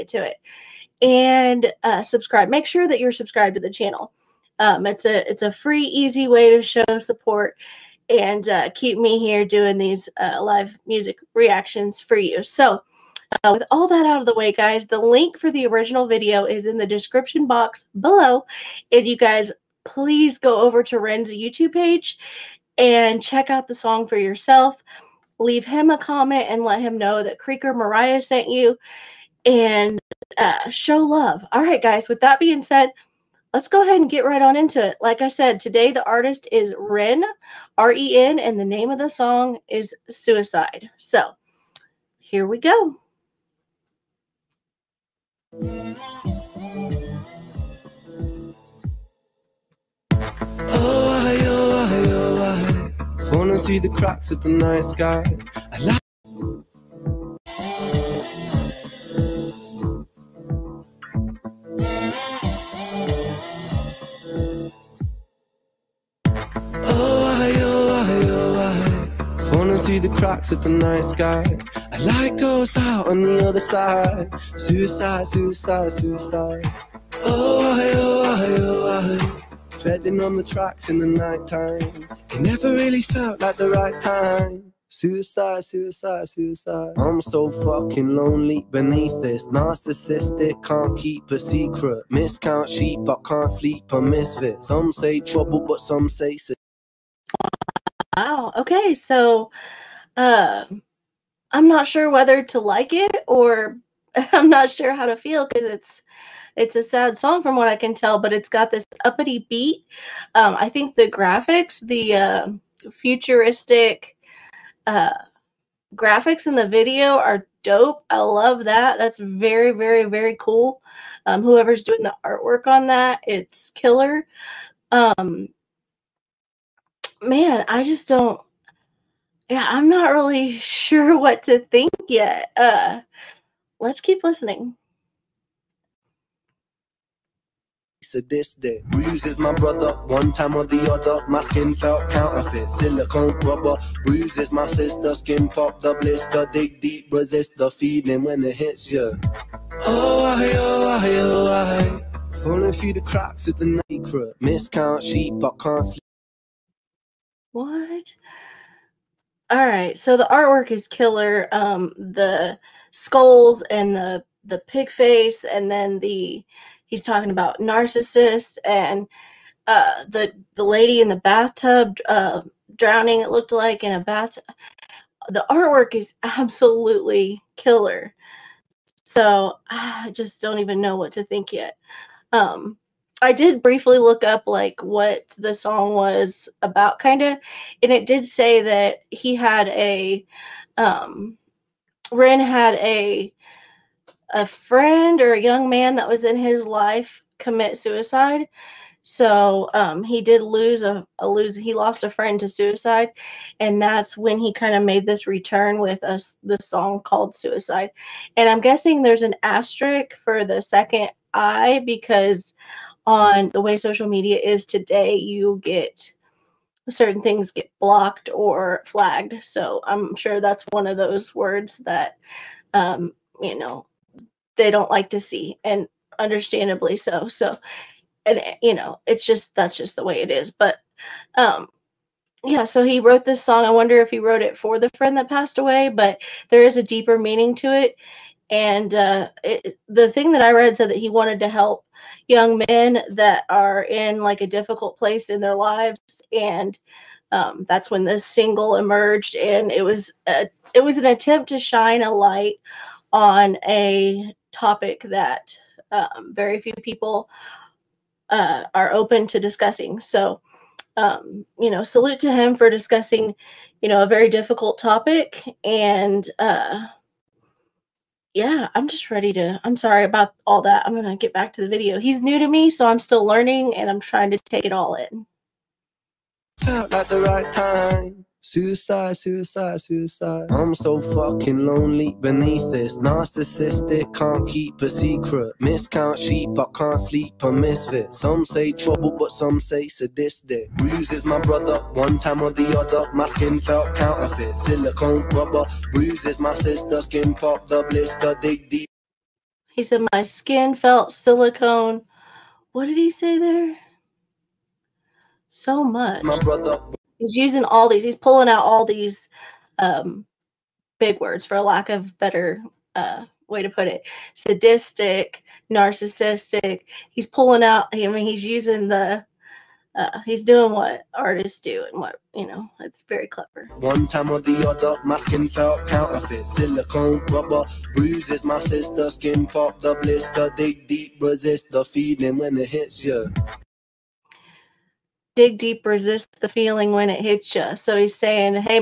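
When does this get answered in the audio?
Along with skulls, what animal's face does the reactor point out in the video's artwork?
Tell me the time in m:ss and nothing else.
2:44.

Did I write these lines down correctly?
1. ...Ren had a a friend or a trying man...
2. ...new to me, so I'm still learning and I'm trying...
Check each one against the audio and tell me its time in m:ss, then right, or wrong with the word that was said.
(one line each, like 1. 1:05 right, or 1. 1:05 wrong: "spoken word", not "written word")
1. 3:12 wrong: "young", not "trying"
2. 4:32 right.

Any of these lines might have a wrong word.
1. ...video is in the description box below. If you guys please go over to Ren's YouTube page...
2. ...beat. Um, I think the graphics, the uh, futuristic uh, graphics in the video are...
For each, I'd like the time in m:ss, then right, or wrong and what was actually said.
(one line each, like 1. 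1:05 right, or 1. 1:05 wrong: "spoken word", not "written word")
1. 0:16 right
2. 1:49 right.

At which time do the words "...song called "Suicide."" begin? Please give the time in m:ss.
3:26.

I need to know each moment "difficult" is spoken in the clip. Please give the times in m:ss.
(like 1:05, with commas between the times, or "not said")
4:04, 4:24.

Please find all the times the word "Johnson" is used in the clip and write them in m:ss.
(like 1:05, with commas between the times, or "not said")
not said.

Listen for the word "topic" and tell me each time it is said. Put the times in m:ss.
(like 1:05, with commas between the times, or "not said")
4:14, 4:24.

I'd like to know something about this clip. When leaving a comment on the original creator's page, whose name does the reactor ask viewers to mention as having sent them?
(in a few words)
Creeker Mariah.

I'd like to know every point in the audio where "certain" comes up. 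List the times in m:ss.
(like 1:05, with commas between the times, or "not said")
3:36.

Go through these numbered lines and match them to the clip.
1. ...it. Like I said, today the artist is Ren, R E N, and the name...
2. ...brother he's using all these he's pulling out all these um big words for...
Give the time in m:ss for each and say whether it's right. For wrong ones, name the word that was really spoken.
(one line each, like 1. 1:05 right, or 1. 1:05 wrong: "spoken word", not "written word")
1. 0:34 right
2. 5:06 right.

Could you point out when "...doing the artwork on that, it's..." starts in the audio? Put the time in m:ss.
2:01.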